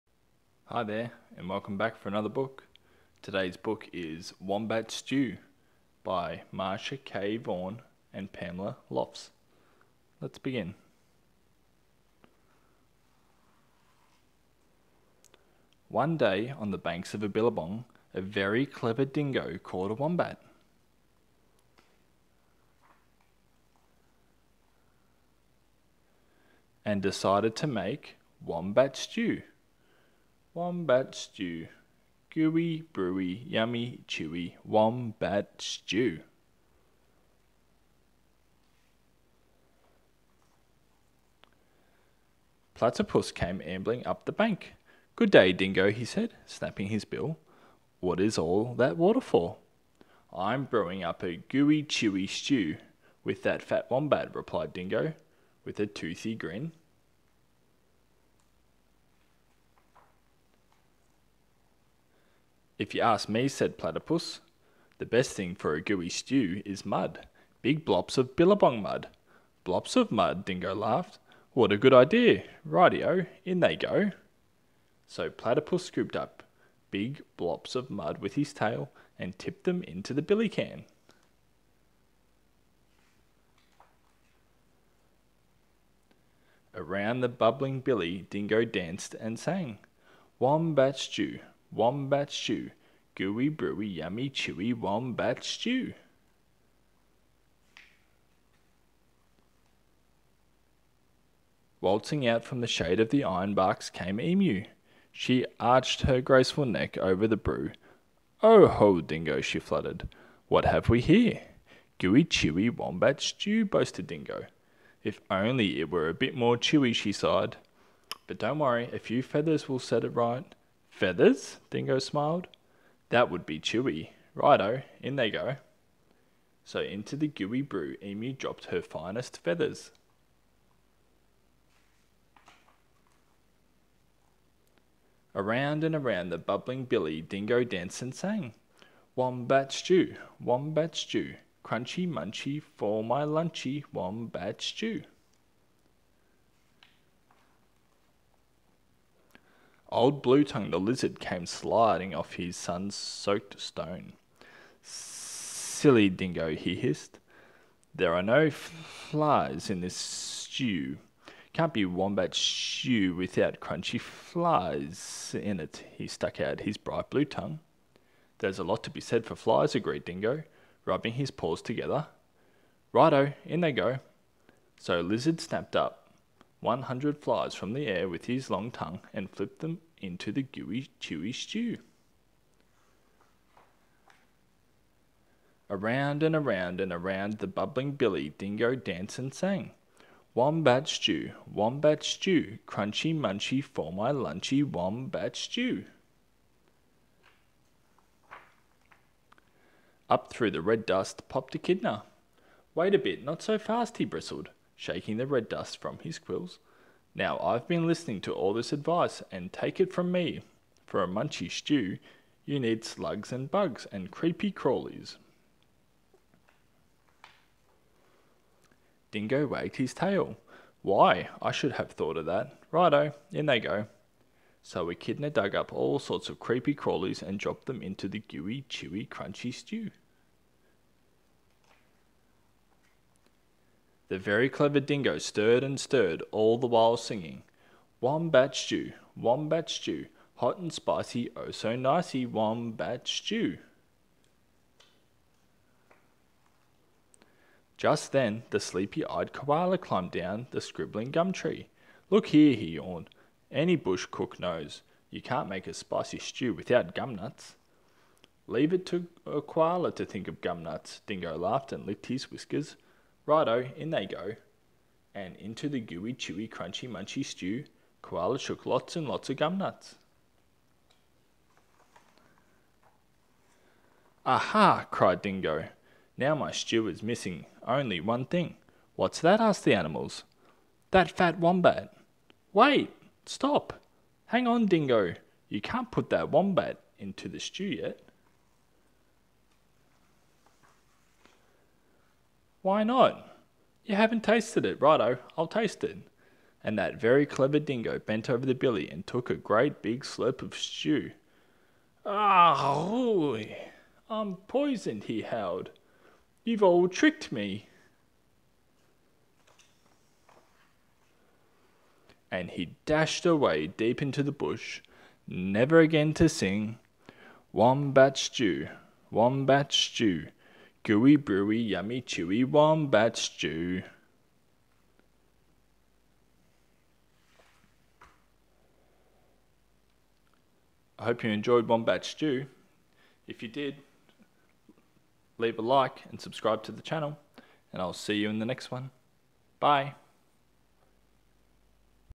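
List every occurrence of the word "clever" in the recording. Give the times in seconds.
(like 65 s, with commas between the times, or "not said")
18 s, 234 s, 297 s.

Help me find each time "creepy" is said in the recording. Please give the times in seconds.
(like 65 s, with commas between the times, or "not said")
214 s, 226 s.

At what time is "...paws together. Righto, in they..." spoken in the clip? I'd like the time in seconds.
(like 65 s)
171 s.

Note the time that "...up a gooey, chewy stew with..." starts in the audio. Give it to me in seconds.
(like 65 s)
51 s.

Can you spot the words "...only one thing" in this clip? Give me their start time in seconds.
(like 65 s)
277 s.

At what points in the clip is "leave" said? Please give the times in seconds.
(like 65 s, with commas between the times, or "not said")
258 s, 335 s.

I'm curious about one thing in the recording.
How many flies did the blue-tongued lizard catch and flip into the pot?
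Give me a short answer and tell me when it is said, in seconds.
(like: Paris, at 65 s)
100, at 176 s.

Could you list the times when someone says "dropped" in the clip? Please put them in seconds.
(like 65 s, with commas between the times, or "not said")
128 s, 227 s.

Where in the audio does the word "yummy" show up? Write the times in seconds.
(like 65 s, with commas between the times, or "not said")
33 s, 93 s, 321 s.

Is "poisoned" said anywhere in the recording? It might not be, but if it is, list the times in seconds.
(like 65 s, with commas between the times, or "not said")
304 s.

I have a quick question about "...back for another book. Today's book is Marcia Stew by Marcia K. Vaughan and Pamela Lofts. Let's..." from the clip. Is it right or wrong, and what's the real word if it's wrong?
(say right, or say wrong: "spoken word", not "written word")
wrong: "Wombat", not "Marcia".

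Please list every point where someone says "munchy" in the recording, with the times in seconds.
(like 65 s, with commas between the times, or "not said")
142 s, 193 s, 211 s, 266 s.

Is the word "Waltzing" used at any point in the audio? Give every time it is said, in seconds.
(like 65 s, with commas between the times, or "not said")
101 s.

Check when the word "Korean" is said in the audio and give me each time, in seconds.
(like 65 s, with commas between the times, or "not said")
not said.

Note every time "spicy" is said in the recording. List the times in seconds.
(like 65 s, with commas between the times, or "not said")
240 s, 255 s.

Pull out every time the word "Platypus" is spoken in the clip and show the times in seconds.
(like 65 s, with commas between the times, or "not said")
42 s, 63 s, 75 s.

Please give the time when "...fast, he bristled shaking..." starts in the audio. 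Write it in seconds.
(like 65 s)
203 s.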